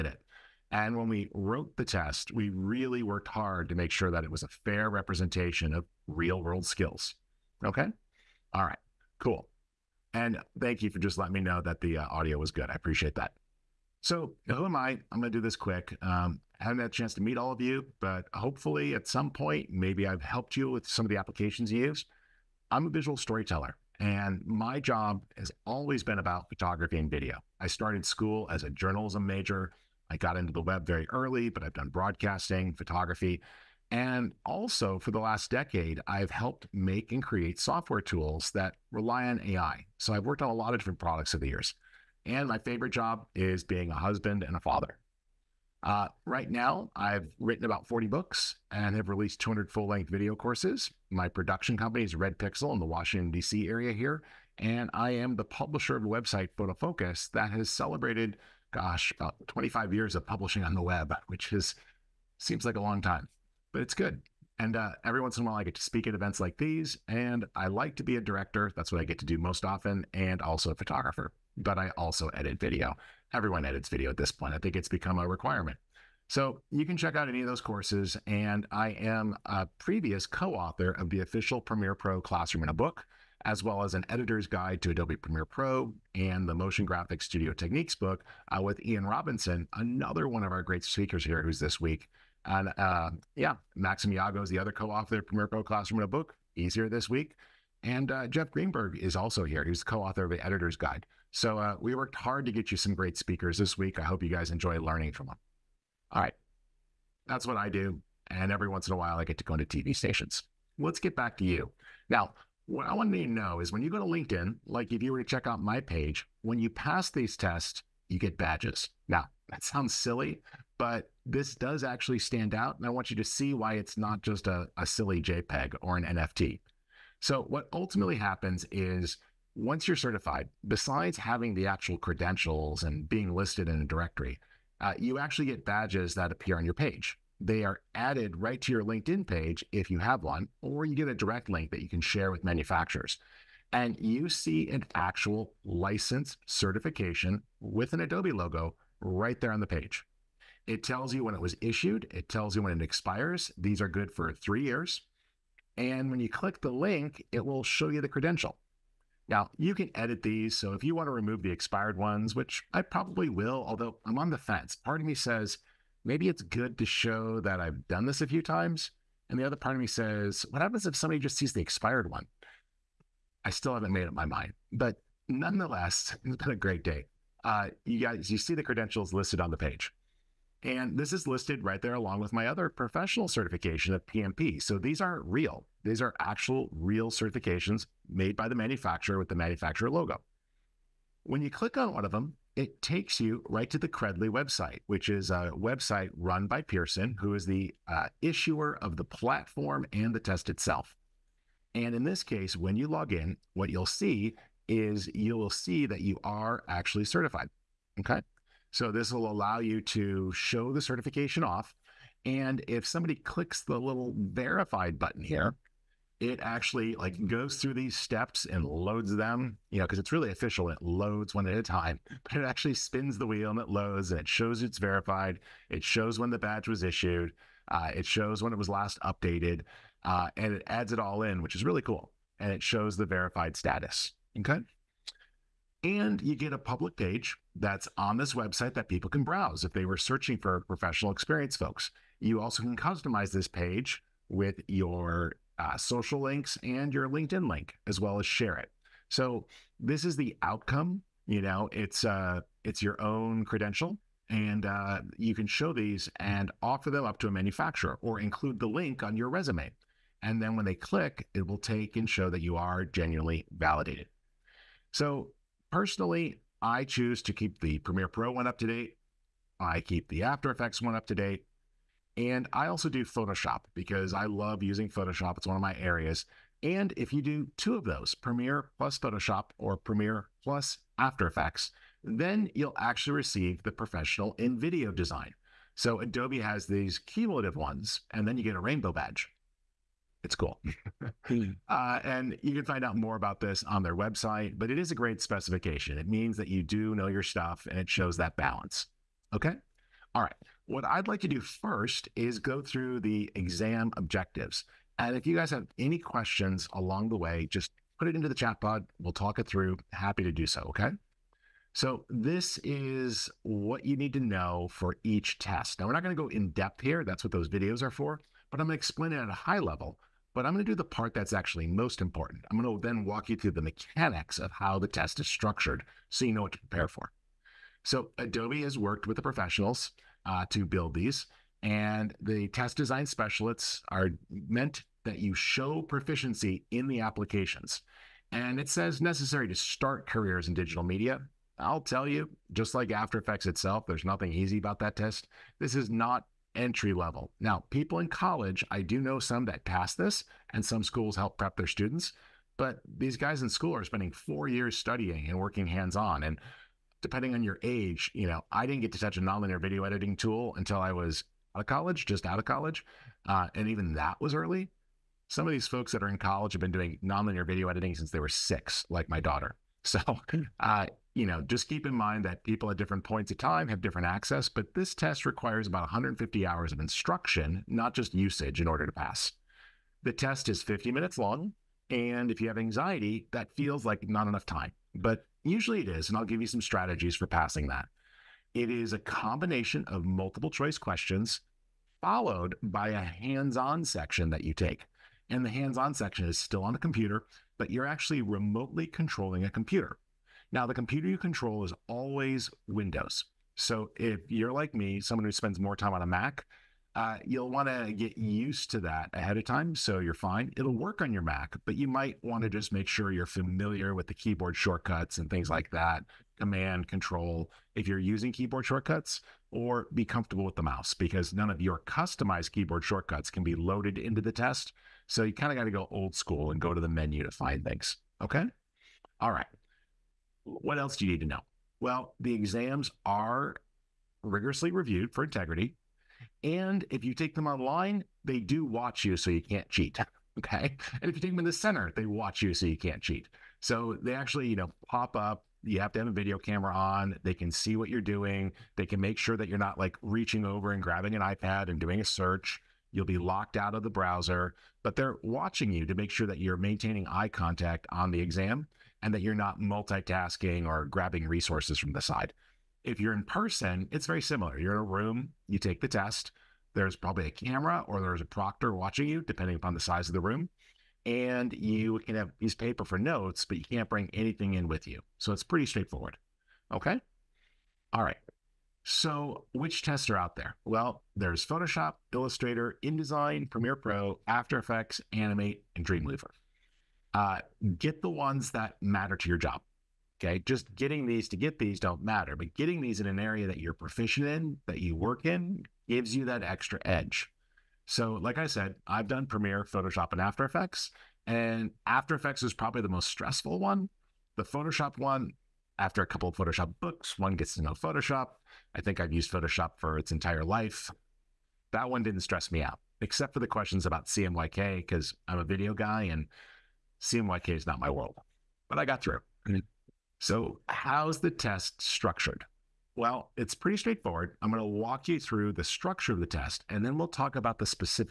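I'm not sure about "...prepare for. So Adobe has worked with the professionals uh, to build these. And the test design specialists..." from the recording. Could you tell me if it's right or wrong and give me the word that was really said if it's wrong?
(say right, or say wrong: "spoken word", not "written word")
right.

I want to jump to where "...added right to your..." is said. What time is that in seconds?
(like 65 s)
137 s.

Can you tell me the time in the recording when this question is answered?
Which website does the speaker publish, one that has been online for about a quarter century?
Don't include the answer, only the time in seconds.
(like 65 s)
56 s.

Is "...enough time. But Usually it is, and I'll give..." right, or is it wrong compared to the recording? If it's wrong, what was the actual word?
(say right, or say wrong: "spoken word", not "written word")
right.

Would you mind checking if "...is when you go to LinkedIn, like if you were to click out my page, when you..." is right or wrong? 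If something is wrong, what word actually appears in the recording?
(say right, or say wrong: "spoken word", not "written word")
wrong: "check", not "click".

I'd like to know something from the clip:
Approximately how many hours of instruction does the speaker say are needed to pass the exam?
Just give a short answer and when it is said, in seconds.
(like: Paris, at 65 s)
150, at 375 s.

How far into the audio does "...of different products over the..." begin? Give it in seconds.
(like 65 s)
40 s.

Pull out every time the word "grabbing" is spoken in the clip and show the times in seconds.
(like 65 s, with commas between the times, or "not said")
450 s, 460 s.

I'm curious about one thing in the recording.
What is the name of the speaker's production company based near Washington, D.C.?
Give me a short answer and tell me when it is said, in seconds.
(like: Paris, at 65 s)
Red Pixel, at 52 s.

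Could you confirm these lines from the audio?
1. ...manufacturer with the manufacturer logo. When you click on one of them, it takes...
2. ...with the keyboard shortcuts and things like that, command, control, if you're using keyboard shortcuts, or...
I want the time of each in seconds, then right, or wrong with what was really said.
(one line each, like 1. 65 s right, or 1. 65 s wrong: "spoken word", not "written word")
1. 188 s right
2. 413 s right.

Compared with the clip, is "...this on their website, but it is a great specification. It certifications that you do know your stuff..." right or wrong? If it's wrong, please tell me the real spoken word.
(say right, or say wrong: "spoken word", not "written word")
wrong: "means", not "certifications".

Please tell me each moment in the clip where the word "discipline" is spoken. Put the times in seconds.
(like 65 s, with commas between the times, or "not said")
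not said.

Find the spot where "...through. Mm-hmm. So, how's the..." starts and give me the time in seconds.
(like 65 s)
519 s.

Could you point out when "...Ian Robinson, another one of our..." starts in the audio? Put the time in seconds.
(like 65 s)
88 s.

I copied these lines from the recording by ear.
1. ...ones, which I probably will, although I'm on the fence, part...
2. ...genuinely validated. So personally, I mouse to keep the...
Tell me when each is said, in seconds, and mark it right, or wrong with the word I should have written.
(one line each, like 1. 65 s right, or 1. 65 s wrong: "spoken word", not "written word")
1. 161 s right
2. 262 s wrong: "choose", not "mouse".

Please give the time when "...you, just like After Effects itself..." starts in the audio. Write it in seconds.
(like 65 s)
342 s.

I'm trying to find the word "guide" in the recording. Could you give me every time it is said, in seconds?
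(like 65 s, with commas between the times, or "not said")
84 s, 100 s.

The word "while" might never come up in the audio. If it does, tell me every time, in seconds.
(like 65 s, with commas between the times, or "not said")
65 s, 108 s.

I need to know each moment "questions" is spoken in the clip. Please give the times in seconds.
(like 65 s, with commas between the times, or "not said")
305 s, 390 s, 513 s.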